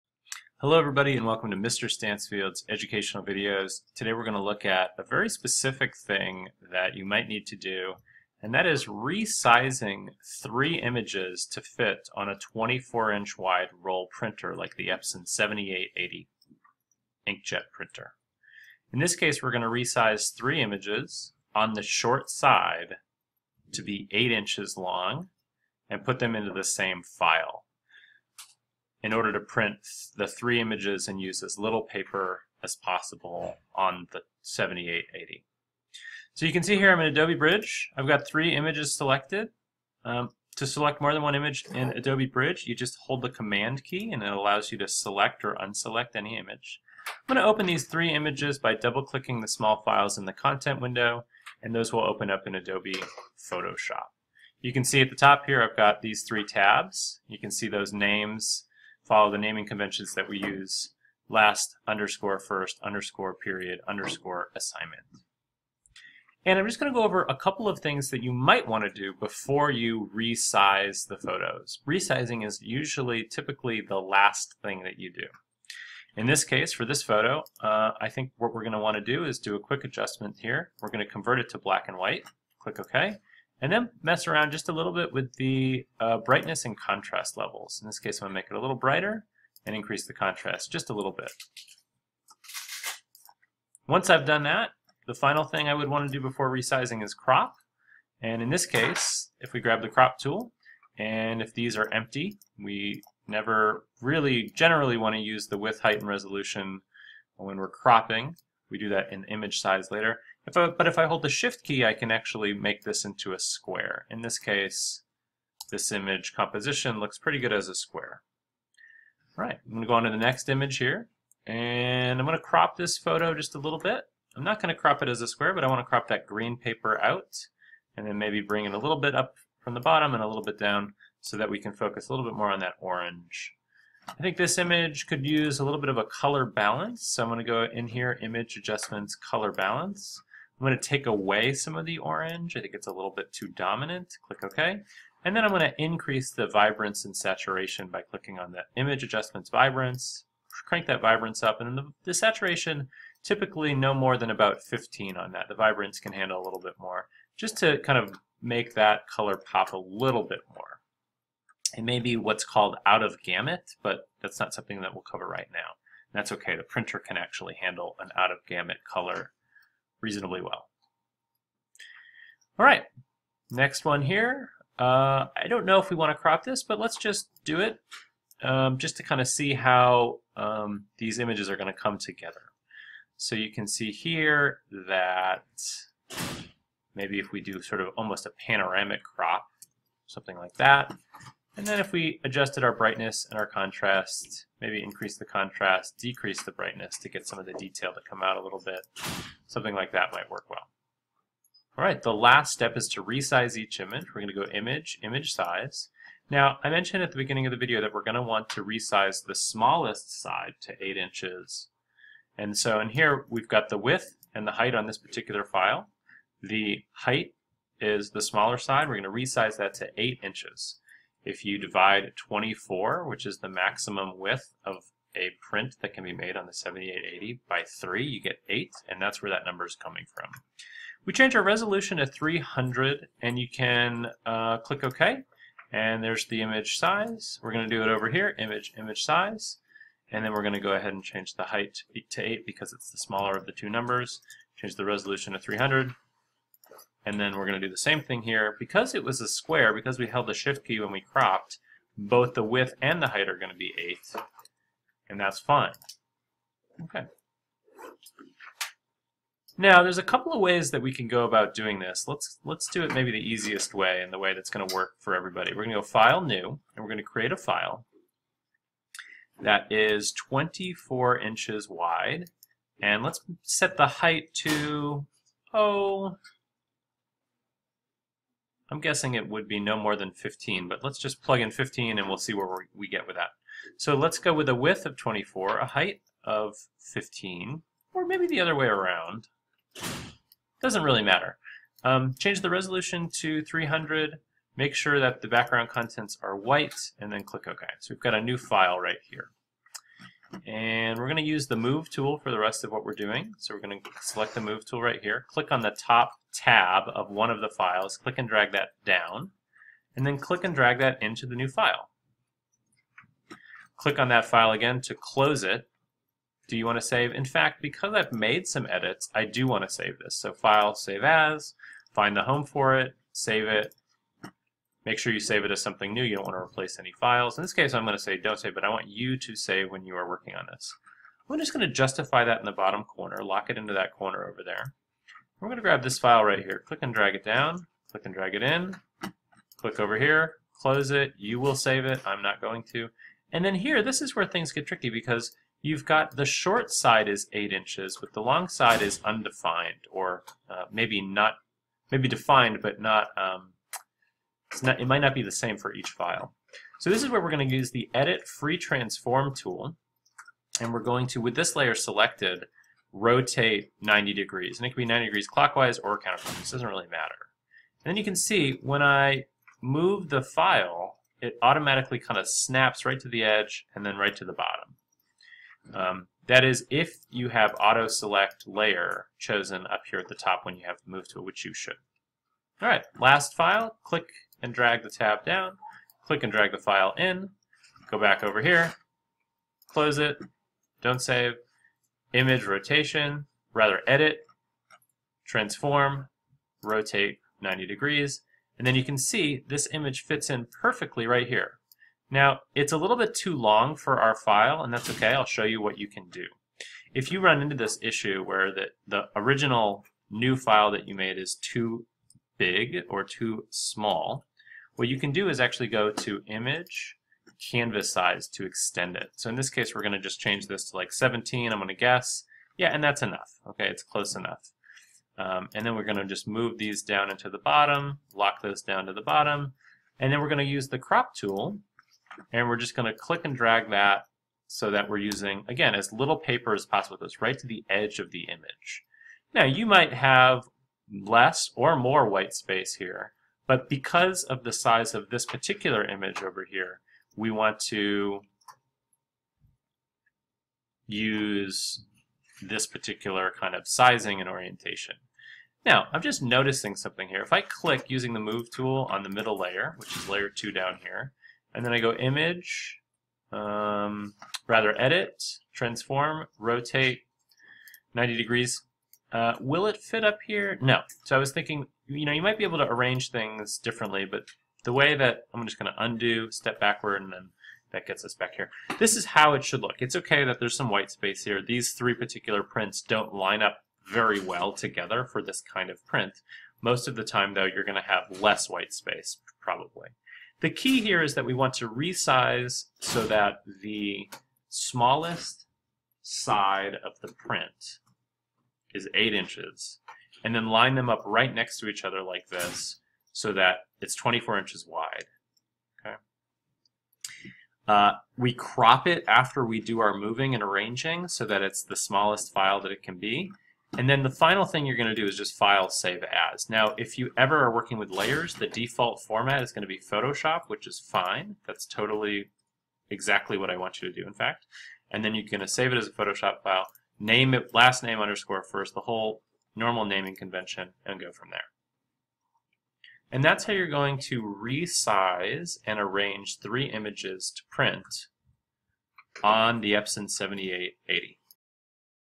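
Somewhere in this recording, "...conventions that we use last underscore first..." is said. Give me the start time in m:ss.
0:59.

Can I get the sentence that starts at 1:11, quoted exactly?
Resizing is usually typically the last thing that you do.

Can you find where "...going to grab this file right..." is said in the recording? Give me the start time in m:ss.
5:35.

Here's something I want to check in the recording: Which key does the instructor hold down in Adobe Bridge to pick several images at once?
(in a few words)
Command.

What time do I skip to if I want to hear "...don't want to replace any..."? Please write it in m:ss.
5:26.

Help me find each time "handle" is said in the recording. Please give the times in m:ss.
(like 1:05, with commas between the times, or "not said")
2:36, 2:47.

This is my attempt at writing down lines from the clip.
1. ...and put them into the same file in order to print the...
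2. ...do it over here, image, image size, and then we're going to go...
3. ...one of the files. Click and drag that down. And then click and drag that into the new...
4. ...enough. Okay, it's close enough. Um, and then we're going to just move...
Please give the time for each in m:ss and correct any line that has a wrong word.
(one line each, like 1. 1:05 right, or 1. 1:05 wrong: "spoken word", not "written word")
1. 0:25 right
2. 3:57 right
3. 5:07 right
4. 7:03 right.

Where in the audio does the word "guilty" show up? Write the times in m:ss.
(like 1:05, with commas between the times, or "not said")
not said.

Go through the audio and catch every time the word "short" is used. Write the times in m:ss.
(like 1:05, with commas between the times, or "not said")
0:21, 5:46.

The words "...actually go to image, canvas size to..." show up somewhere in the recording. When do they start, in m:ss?
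6:55.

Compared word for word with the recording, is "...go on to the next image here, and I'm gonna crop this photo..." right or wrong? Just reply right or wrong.
right.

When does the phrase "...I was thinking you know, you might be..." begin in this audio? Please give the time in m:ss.
7:51.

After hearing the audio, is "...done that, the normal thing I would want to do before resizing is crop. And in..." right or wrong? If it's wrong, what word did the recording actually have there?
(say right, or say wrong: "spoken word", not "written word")
wrong: "final", not "normal".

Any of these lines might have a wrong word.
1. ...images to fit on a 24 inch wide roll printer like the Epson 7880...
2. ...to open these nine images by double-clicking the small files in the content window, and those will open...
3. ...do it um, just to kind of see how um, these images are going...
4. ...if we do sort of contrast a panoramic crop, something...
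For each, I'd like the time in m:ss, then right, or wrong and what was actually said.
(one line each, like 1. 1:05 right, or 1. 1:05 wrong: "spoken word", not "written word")
1. 0:10 right
2. 0:47 wrong: "three", not "nine"
3. 2:57 right
4. 3:07 wrong: "almost", not "contrast".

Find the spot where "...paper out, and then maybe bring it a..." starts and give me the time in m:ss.
2:06.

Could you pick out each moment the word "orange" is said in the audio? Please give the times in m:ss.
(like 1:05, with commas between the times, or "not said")
2:12, 2:21.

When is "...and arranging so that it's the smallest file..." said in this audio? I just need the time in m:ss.
8:30.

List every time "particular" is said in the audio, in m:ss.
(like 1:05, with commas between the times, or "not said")
3:34, 7:25, 7:32, 8:01.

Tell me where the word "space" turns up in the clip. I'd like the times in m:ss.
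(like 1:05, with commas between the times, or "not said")
7:22, 8:00, 8:08.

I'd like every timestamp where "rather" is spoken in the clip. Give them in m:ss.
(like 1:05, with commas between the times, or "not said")
6:33, 7:44.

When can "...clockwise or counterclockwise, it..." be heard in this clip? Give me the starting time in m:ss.
6:05.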